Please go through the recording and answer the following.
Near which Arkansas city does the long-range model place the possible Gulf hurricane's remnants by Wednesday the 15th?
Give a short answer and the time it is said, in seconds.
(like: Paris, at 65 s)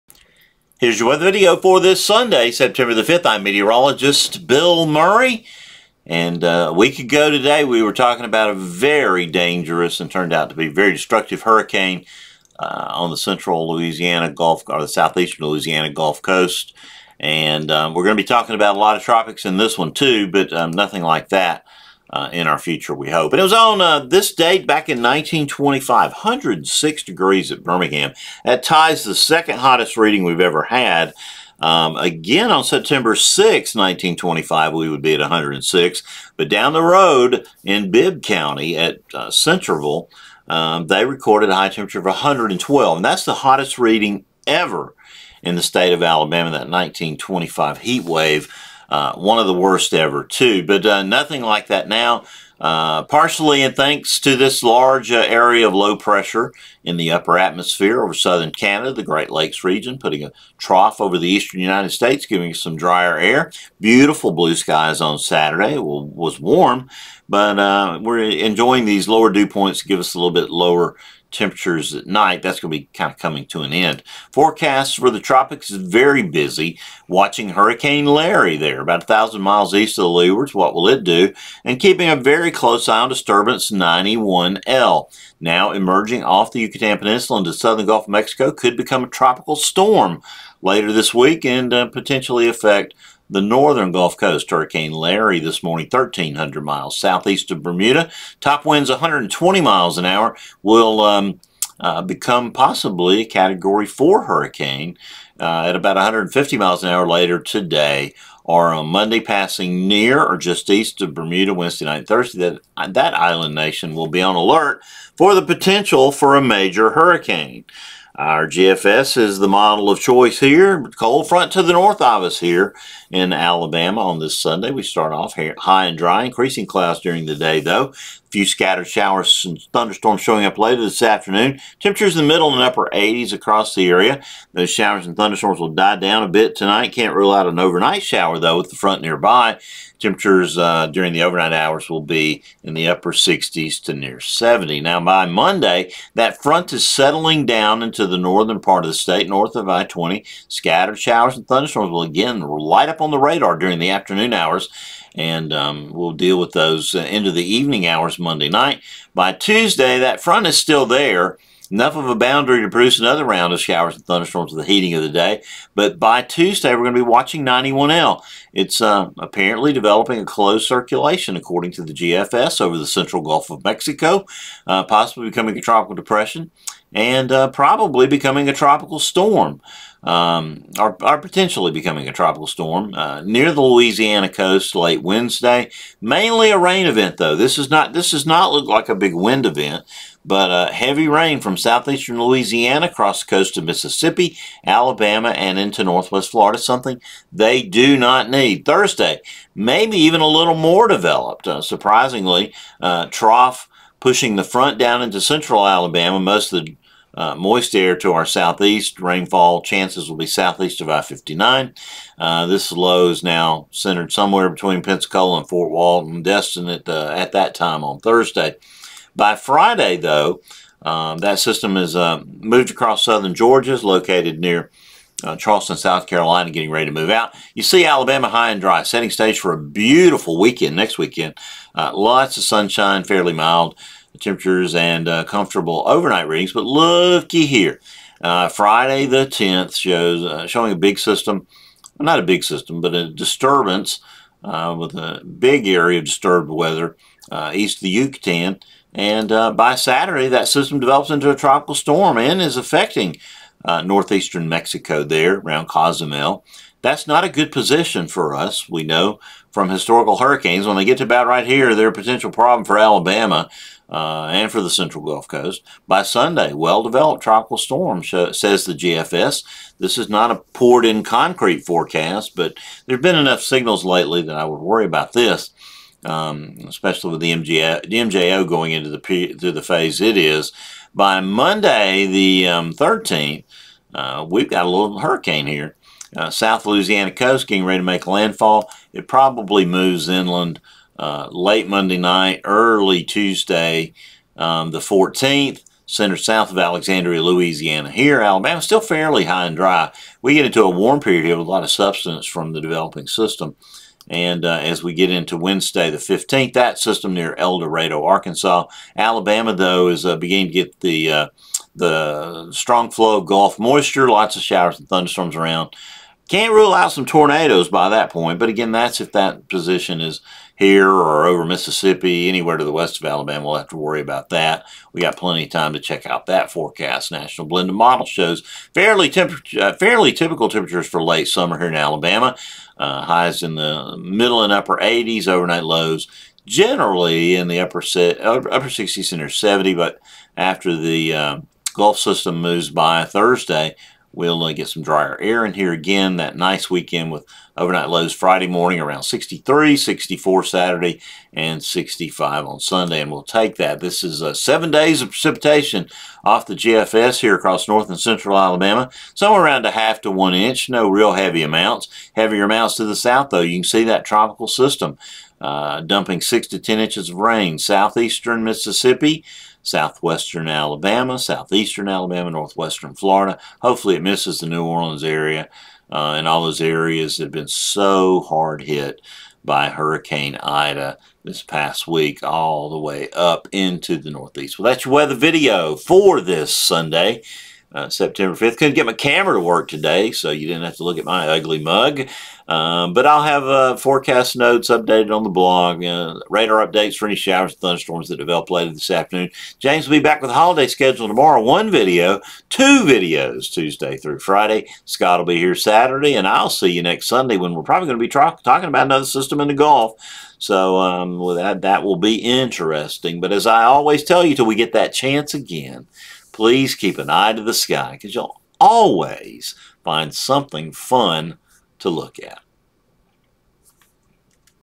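El Dorado, at 307 s.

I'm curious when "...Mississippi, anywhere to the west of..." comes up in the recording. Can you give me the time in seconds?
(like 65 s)
321 s.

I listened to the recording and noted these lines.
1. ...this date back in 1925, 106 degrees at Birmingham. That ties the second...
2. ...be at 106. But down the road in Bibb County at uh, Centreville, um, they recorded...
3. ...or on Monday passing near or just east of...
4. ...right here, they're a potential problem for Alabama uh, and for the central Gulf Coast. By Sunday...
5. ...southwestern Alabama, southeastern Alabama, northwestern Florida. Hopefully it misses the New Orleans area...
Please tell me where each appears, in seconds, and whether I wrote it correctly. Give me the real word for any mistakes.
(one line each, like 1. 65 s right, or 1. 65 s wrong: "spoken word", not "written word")
1. 24 s right
2. 35 s right
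3. 108 s right
4. 261 s right
5. 369 s right.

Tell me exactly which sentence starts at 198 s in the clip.
Thursday, maybe even a little more developed.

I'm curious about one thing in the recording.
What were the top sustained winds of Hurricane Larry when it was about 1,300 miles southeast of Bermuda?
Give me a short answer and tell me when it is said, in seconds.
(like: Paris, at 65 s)
120 miles an hour, at 98 s.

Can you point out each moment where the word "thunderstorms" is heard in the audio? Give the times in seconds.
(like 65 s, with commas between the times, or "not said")
129 s, 135 s, 151 s, 164 s, 314 s, 397 s.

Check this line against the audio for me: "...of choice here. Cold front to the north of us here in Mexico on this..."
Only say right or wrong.
wrong.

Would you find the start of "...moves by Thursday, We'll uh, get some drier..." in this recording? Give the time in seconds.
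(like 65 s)
342 s.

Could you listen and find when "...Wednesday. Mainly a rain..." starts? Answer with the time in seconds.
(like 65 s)
185 s.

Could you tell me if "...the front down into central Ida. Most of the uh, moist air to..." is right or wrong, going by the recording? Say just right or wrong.
wrong.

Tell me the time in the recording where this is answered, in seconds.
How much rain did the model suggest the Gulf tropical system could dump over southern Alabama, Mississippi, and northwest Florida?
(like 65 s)
366 s.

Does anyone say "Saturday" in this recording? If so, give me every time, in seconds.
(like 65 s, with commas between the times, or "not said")
65 s, 249 s, 350 s, 405 s.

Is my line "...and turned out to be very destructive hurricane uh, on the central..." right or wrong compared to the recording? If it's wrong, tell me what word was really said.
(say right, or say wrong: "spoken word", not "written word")
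right.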